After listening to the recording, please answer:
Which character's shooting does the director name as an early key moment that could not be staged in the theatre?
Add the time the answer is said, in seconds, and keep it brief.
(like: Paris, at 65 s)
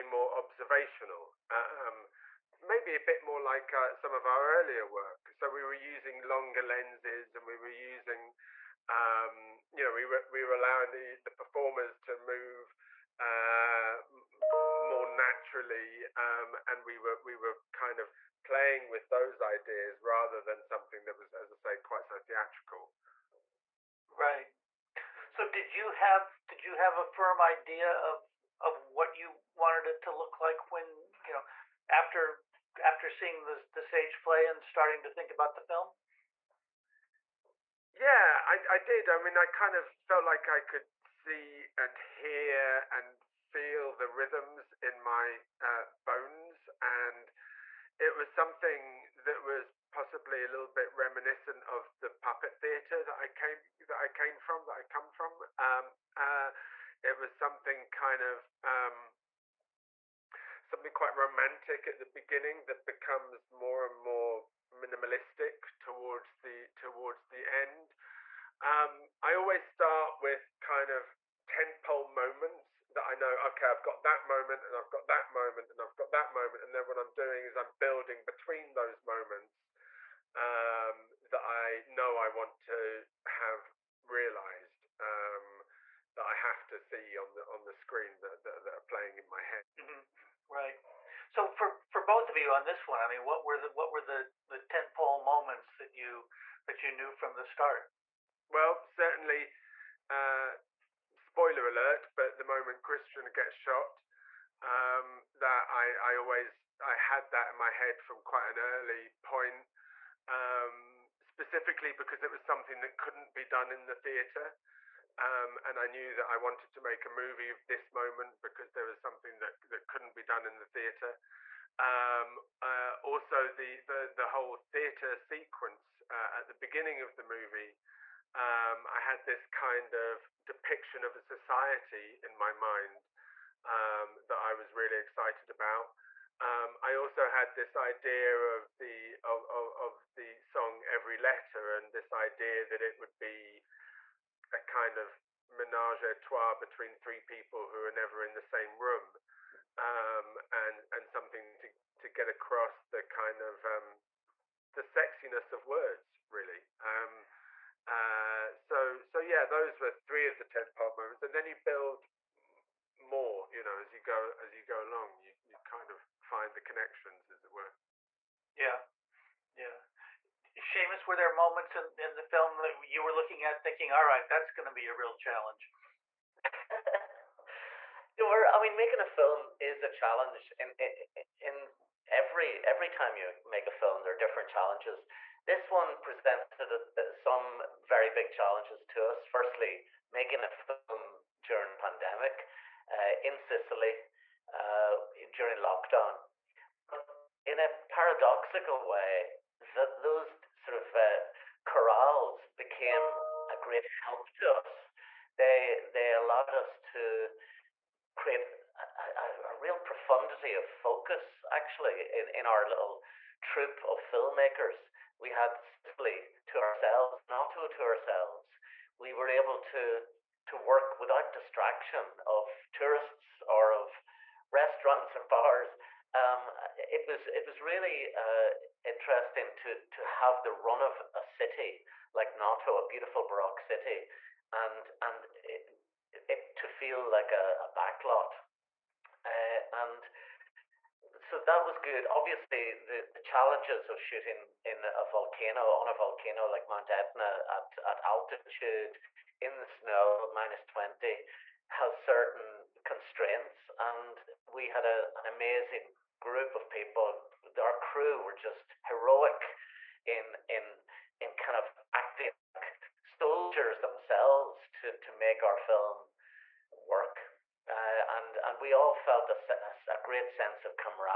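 Christian, at 102 s.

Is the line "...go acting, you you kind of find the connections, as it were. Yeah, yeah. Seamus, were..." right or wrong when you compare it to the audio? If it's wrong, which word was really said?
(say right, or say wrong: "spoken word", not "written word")
wrong: "along", not "acting".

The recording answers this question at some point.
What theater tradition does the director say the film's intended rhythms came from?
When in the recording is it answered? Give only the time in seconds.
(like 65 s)
52 s.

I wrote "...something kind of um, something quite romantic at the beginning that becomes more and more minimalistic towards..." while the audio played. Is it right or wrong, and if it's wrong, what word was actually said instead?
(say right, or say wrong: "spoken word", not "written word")
right.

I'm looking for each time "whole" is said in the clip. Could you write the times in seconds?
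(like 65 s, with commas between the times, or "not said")
124 s.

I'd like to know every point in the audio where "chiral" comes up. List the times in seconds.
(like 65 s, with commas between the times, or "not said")
not said.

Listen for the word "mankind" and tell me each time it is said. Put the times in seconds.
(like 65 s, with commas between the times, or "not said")
not said.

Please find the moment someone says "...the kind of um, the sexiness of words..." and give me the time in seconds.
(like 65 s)
152 s.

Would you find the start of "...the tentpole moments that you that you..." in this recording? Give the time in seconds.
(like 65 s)
94 s.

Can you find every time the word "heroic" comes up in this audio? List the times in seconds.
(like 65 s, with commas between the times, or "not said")
258 s.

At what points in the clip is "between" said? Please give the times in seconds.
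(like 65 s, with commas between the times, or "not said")
78 s, 146 s.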